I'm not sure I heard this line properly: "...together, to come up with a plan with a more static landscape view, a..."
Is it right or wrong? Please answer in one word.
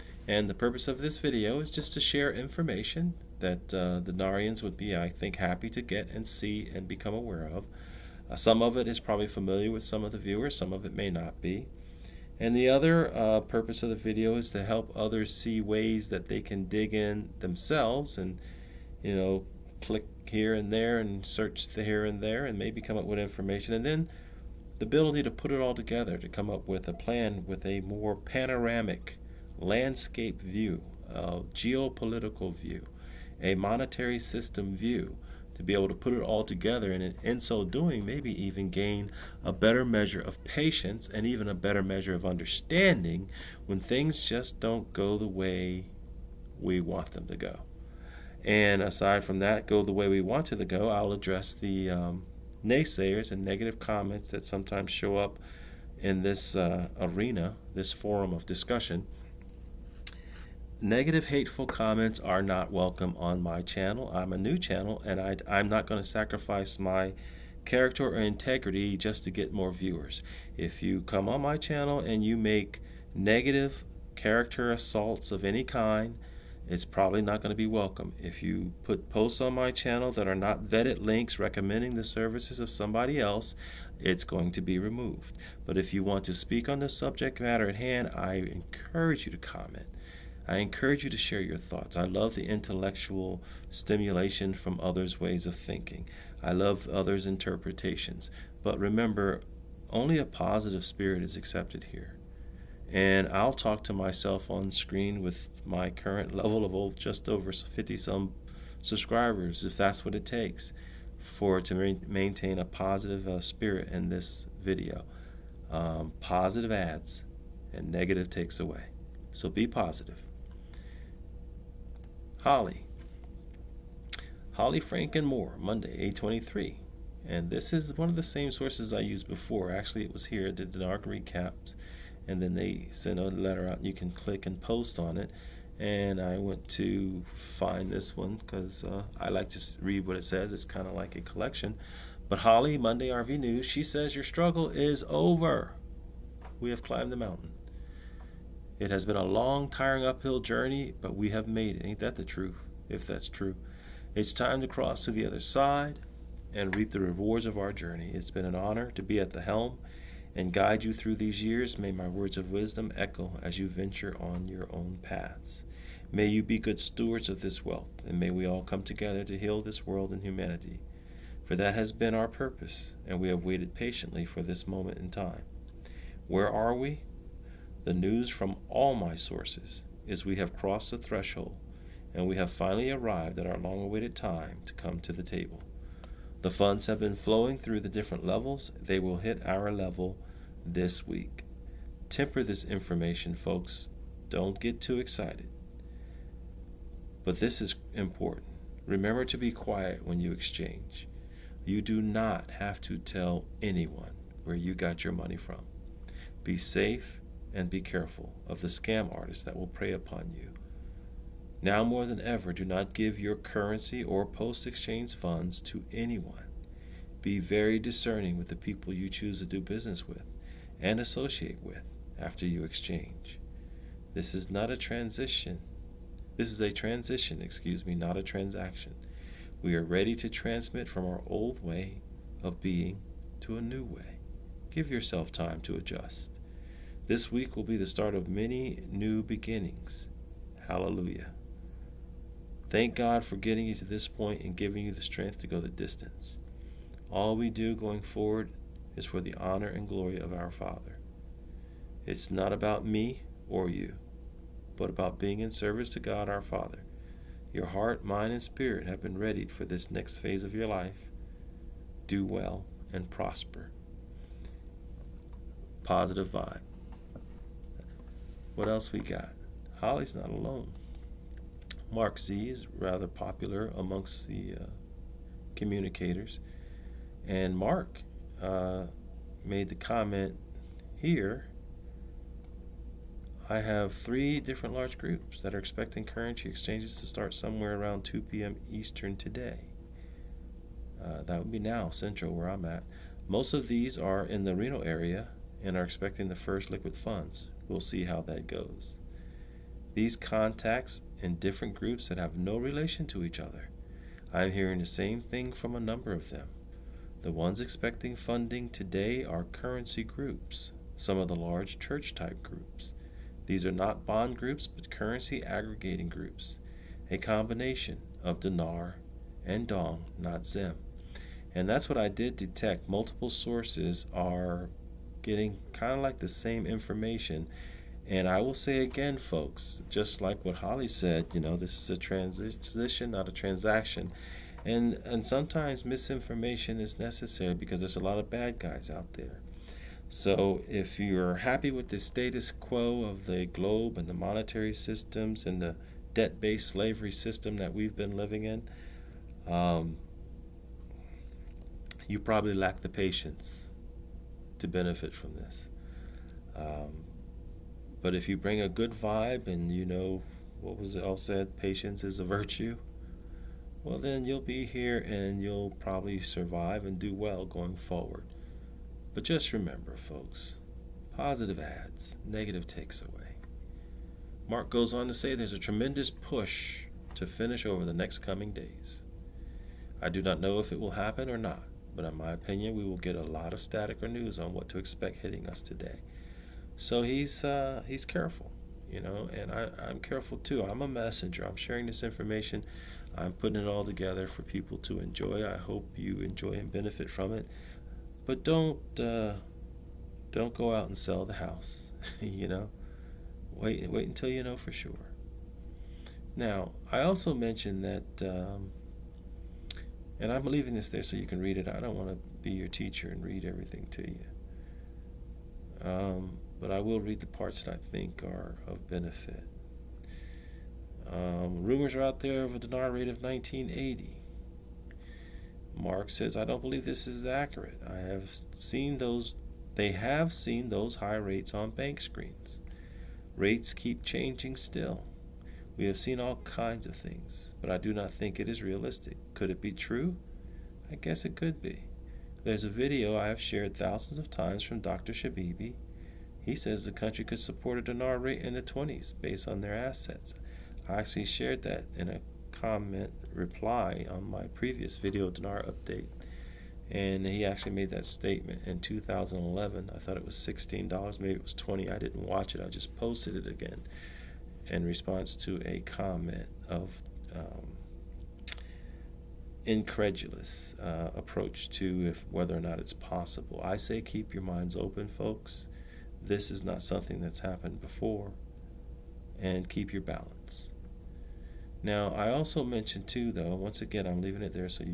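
wrong.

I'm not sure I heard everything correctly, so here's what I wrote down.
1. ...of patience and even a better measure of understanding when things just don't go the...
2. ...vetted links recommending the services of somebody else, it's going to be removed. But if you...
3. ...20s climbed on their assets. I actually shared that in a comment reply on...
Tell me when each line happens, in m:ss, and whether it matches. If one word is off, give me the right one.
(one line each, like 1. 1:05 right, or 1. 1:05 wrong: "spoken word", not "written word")
1. 0:40 right
2. 1:20 right
3. 7:28 wrong: "based", not "climbed".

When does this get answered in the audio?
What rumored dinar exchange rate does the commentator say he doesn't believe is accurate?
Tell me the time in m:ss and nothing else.
7:03.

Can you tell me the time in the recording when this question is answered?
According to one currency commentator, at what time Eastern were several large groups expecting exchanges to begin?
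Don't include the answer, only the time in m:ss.
4:48.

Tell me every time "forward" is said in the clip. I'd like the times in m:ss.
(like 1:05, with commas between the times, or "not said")
4:08, 6:07.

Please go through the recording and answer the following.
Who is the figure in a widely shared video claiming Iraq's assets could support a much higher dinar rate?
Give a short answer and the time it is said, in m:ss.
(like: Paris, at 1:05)
Dr. Shabibi, at 7:24.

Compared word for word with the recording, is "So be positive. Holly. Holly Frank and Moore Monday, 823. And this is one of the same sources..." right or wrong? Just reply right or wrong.
right.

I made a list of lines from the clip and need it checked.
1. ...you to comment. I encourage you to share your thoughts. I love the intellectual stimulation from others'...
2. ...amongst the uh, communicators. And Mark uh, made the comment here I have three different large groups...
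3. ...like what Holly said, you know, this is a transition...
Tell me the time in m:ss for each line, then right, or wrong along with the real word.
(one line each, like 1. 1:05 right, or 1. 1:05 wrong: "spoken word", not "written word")
1. 1:29 right
2. 4:33 right
3. 5:30 right.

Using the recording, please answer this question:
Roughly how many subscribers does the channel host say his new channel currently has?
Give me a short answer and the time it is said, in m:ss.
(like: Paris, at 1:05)
just over 50, at 1:46.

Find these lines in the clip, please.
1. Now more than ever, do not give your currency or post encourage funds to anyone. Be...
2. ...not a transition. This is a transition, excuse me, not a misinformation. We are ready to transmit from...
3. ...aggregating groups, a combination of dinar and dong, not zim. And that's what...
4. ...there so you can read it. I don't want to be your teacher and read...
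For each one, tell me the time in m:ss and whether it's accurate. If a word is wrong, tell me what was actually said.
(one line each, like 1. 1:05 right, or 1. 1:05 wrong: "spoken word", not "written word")
1. 3:31 wrong: "exchange", not "encourage"
2. 3:44 wrong: "transaction", not "misinformation"
3. 5:15 right
4. 6:50 right.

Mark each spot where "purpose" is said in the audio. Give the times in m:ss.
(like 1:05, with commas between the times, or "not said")
0:00, 0:13, 2:52.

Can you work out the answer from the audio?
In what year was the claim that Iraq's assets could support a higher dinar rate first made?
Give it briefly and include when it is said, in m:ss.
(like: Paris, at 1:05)
2011, at 7:38.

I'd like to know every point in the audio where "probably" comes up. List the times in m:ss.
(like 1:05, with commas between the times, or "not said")
0:08, 1:16, 5:52, 6:05.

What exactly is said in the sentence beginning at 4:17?
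Your heart, mind, and spirit have been readied for this next phase of your life.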